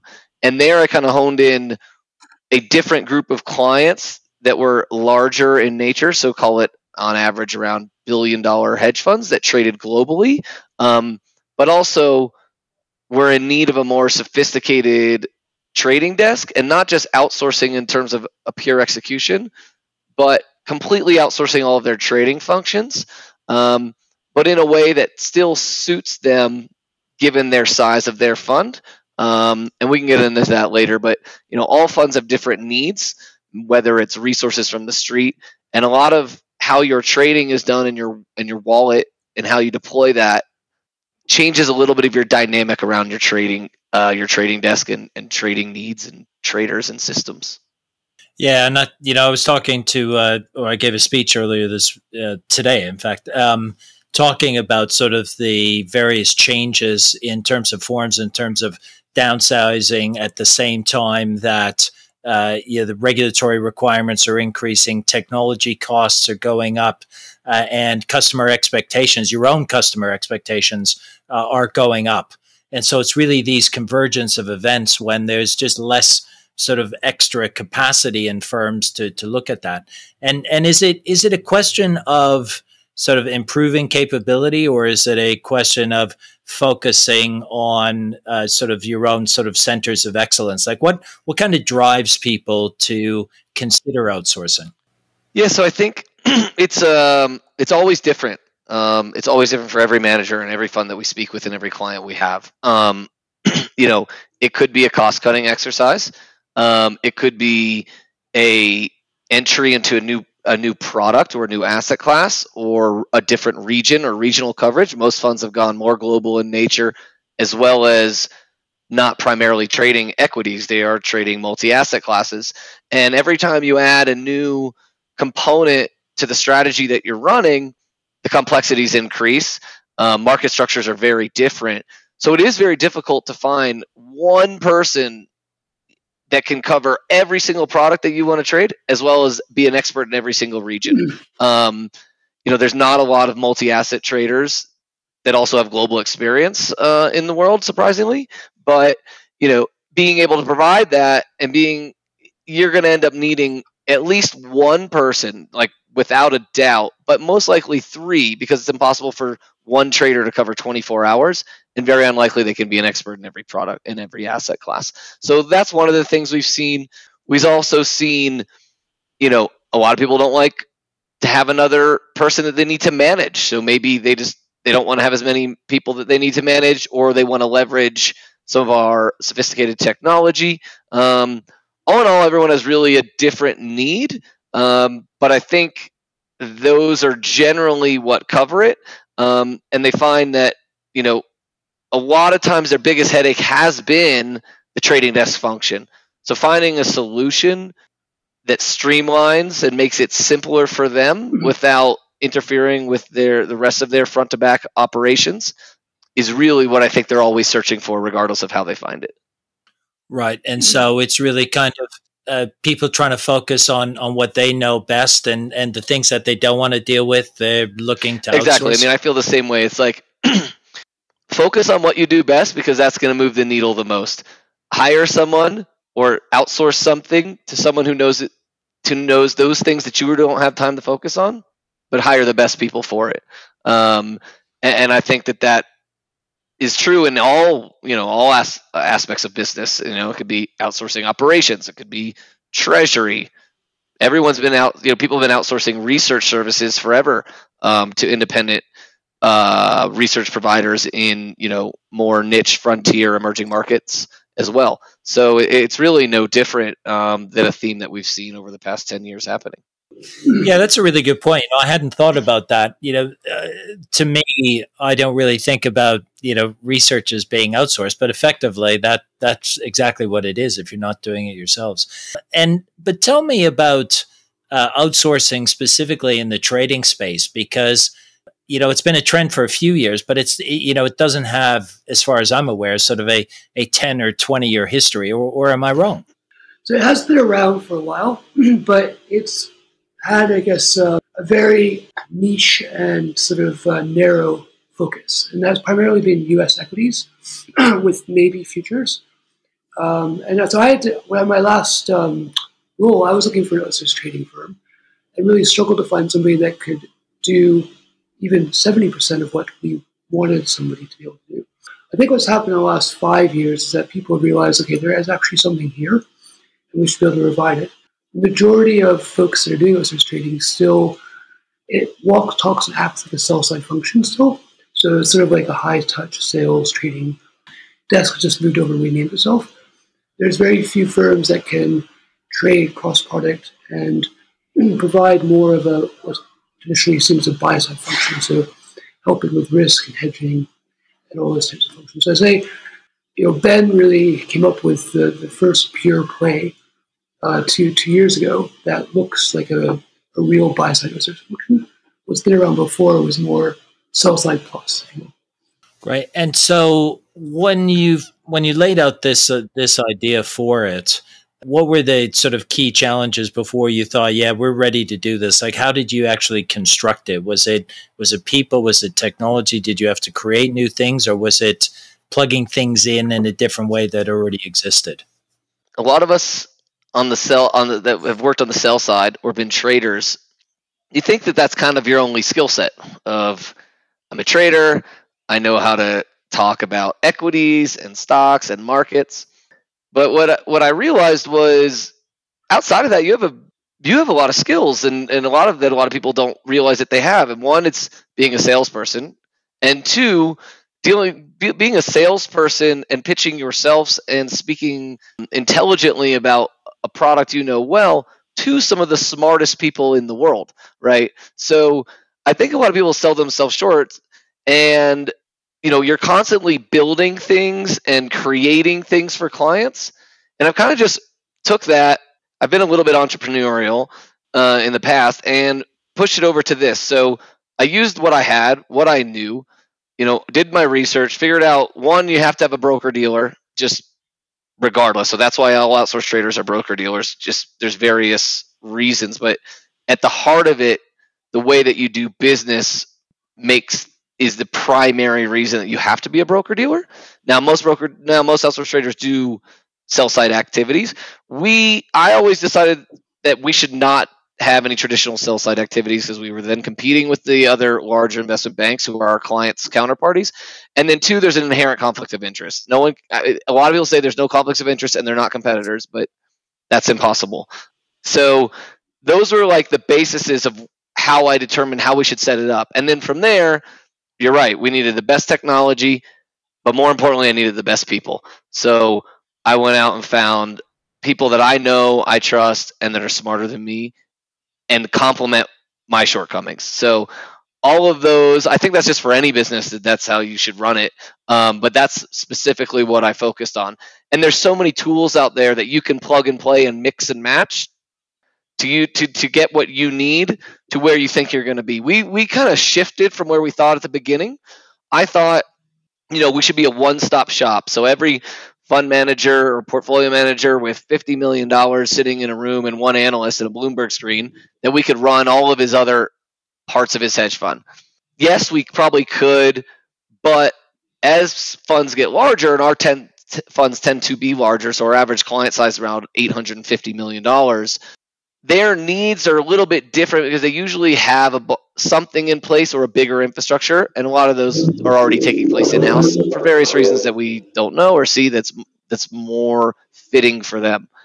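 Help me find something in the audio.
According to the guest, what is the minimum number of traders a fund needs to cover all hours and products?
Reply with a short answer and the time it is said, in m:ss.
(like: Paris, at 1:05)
3, at 2:37.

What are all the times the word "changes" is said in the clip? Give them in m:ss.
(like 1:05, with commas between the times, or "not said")
0:41, 0:56.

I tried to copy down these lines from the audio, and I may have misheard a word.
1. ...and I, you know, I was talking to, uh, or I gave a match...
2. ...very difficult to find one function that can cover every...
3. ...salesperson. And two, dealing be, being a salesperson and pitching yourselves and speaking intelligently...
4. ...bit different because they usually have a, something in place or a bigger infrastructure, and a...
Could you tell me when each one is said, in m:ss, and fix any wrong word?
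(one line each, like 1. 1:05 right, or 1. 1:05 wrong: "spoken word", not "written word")
1. 0:48 wrong: "speech", not "match"
2. 2:12 wrong: "person", not "function"
3. 6:38 right
4. 8:49 right.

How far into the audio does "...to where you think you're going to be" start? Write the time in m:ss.
8:20.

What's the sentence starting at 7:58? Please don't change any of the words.
So I went out and found people that I know, I trust, and that are smarter than me and complement my shortcomings.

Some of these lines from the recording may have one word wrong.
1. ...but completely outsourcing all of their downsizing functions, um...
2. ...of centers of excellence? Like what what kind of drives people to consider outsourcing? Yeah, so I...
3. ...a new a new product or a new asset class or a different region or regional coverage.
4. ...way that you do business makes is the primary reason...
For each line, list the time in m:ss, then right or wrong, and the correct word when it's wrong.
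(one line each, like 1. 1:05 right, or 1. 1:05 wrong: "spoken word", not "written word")
1. 0:20 wrong: "trading", not "downsizing"
2. 1:29 right
3. 1:49 right
4. 7:21 right.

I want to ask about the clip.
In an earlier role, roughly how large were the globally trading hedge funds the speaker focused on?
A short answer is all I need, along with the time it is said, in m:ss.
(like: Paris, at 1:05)
1 billion dollars, at 0:08.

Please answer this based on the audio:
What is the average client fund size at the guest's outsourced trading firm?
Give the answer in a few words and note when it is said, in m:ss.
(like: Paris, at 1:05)
$850 million, at 8:46.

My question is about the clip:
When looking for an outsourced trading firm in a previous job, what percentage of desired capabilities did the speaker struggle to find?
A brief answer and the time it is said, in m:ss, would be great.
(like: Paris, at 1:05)
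70%, at 5:08.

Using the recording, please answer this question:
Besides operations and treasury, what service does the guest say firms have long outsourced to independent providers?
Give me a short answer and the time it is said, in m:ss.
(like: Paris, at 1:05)
Research services, at 4:05.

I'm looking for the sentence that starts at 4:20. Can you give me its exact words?
Yeah, that's a really good point.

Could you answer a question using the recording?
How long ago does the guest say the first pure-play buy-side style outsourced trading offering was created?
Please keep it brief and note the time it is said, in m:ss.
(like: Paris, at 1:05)
2 years, at 5:47.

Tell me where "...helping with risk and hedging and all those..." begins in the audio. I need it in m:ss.
5:39.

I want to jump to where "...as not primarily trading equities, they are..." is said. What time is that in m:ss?
1:57.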